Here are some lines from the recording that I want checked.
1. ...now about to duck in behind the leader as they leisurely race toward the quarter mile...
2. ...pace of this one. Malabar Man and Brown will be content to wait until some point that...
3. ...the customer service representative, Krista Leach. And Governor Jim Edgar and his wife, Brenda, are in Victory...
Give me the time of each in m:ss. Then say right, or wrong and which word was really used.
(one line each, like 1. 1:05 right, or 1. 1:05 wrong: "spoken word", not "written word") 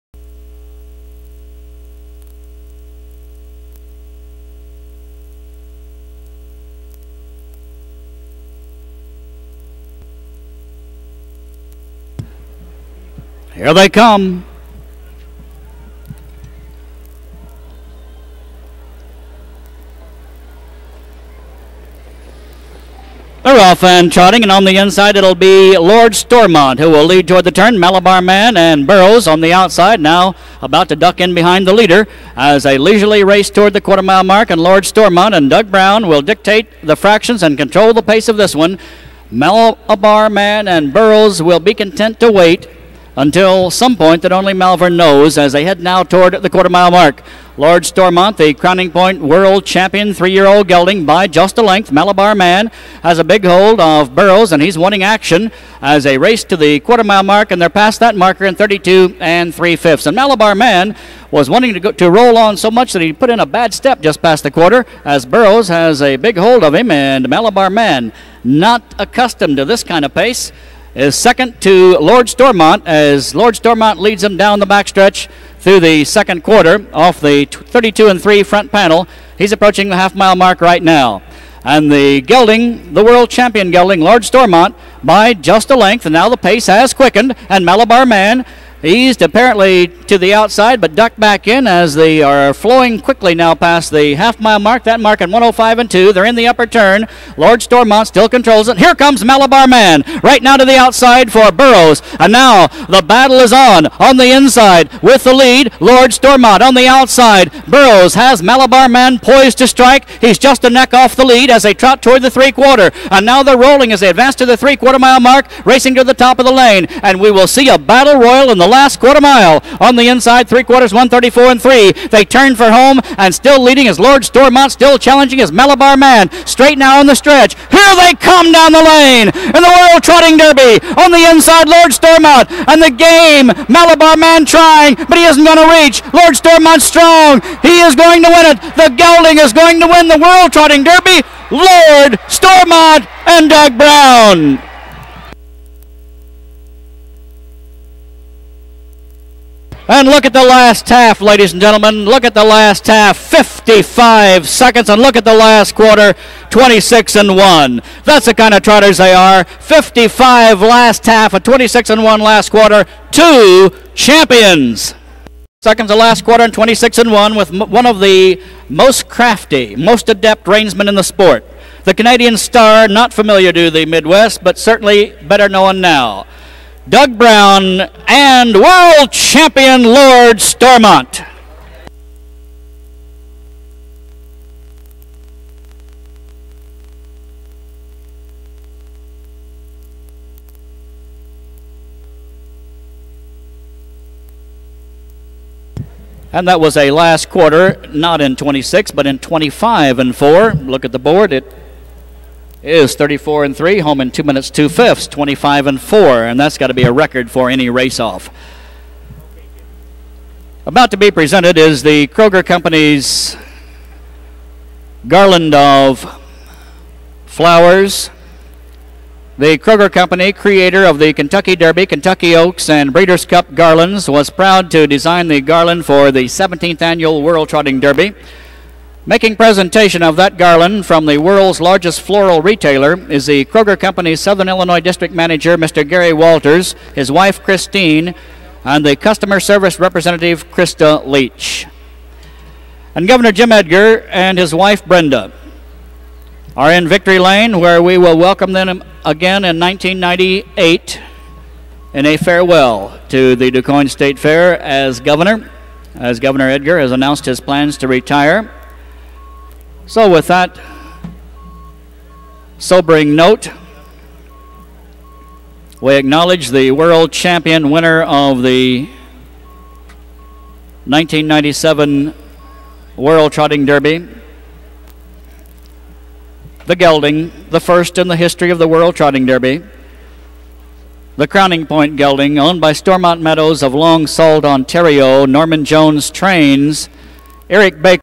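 1. 0:30 right
2. 0:38 wrong: "Burroughs", not "Brown"
3. 3:58 right.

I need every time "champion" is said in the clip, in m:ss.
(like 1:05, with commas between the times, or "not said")
0:49, 1:23, 2:43, 2:59, 4:27.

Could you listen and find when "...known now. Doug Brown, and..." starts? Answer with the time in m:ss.
2:55.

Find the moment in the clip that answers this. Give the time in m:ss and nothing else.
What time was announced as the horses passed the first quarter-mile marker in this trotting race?
0:58.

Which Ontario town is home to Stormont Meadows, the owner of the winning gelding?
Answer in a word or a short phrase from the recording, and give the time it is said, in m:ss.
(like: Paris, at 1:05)
Long Sault, at 4:43.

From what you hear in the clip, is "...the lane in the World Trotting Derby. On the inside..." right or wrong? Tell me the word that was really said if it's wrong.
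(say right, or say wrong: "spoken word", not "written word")
right.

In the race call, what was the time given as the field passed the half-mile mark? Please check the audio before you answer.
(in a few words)
1:05 2/5.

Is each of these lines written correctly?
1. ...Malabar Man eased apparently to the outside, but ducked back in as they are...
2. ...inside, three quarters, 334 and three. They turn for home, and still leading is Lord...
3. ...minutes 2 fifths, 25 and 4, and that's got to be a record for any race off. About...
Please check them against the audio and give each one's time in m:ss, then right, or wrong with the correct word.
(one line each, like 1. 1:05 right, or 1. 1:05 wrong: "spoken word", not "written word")
1. 1:27 right
2. 2:00 wrong: "134", not "334"
3. 3:24 right.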